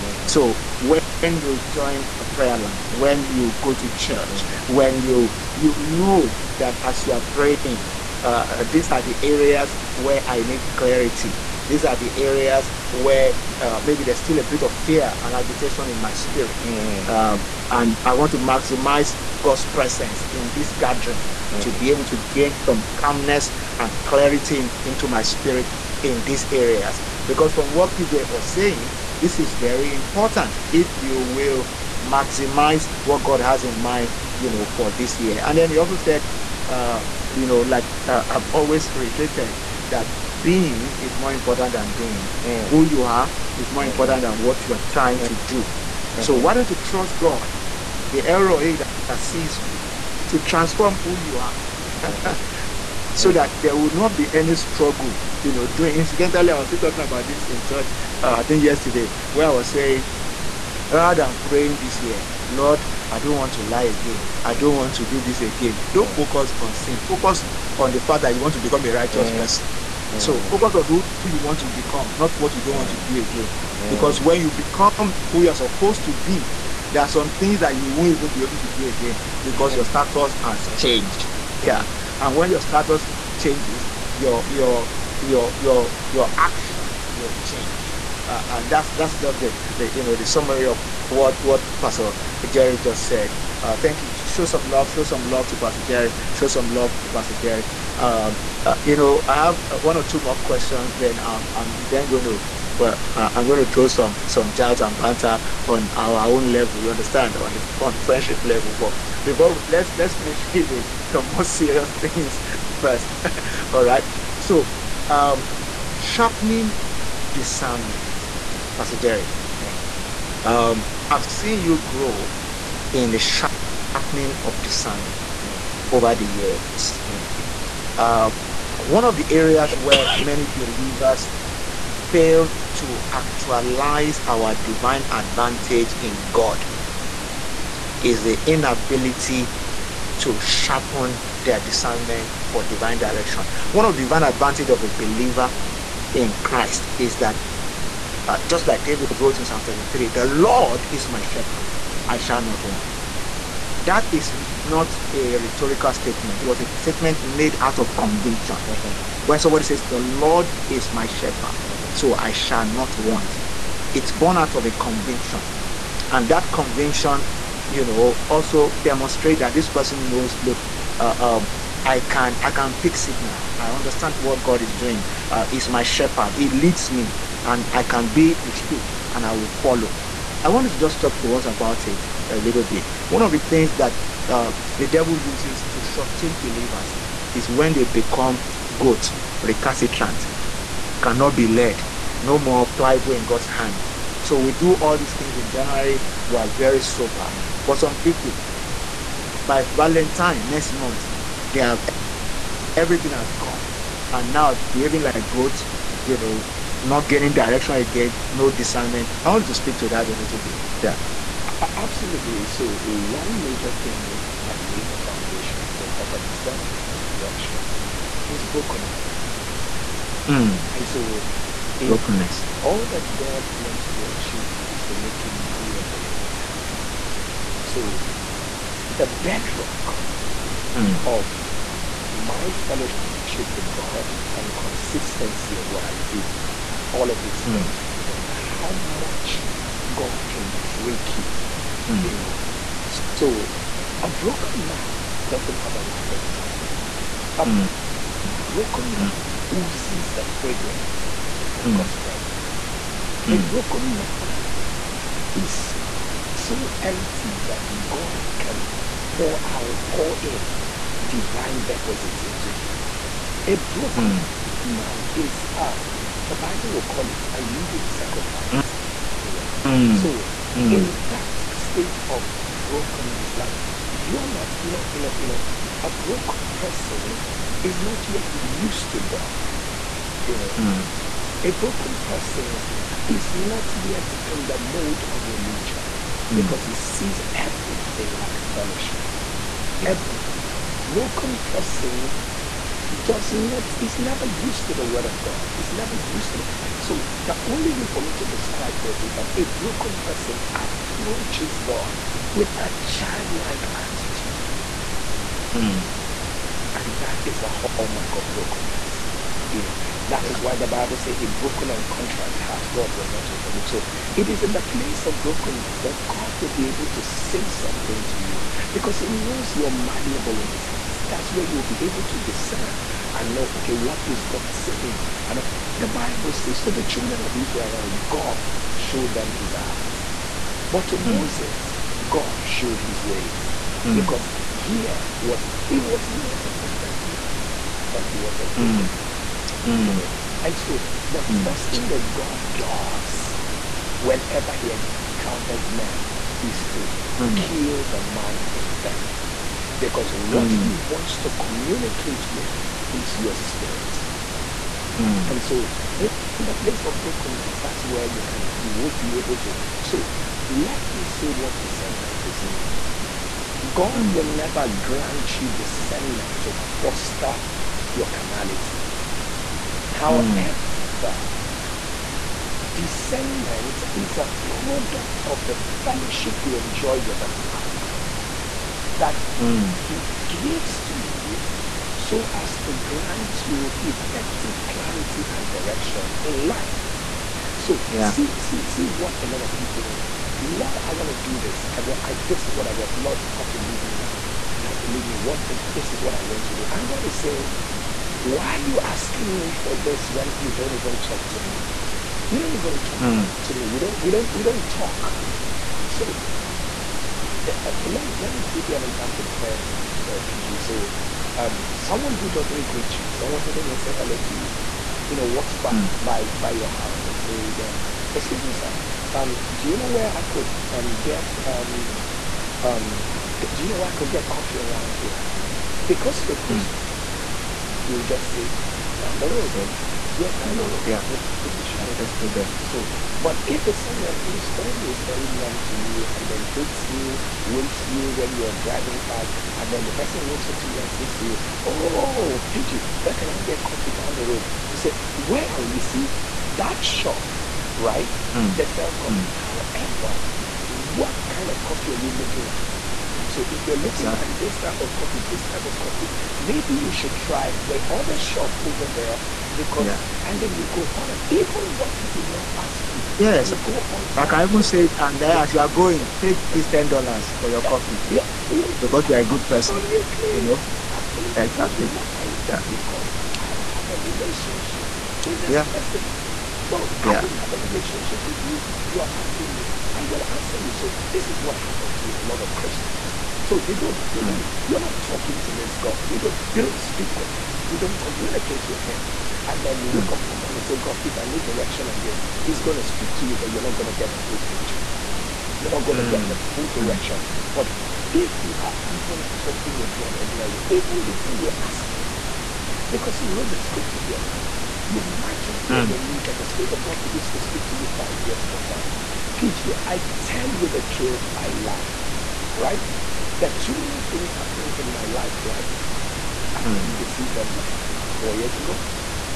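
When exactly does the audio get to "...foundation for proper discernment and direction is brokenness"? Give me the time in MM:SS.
03:34.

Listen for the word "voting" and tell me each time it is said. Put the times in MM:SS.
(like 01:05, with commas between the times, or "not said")
not said.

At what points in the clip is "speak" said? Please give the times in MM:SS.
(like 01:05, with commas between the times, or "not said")
03:29, 08:06, 08:12, 08:27.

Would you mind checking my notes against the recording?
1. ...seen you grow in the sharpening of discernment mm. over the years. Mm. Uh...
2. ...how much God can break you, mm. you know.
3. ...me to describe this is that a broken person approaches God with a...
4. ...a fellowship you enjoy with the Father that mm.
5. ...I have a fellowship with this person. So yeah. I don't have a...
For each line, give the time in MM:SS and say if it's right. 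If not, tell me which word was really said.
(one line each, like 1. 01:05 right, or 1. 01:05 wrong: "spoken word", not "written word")
1. 02:01 right
2. 03:58 right
3. 04:58 right
4. 06:15 right
5. 07:53 wrong: "relationship", not "fellowship".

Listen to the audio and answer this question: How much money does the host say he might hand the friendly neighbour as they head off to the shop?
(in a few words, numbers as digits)
$10.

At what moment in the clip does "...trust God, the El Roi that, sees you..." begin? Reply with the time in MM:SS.
00:46.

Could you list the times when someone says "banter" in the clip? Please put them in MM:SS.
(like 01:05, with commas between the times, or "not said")
01:44.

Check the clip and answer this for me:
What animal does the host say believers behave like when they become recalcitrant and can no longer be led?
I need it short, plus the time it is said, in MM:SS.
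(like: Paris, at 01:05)
goats, at 03:25.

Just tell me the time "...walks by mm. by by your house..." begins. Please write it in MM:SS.
06:55.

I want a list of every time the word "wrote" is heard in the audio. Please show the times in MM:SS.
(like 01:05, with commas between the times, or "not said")
02:29, 08:23.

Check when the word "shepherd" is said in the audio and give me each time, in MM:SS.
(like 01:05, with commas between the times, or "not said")
02:31, 02:41, 02:55.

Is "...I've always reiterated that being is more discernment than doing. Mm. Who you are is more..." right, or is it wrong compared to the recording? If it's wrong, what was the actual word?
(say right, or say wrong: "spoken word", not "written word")
wrong: "important", not "discernment".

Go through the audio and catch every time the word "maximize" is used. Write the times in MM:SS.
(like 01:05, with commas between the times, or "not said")
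00:18, 00:32.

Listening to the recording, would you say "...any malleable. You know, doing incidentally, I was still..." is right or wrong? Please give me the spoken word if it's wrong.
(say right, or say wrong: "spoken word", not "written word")
wrong: "struggle", not "malleable".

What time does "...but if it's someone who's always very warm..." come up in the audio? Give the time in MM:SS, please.
07:13.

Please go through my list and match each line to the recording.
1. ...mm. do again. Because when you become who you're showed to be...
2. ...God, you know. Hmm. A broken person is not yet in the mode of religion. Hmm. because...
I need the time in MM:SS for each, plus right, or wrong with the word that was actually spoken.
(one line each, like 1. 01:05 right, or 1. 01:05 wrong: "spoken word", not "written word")
1. 01:12 wrong: "supposed", not "showed"
2. 04:39 right.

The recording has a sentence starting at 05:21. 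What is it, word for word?
That's where you'll be able to discern and know, okay, what is God saying?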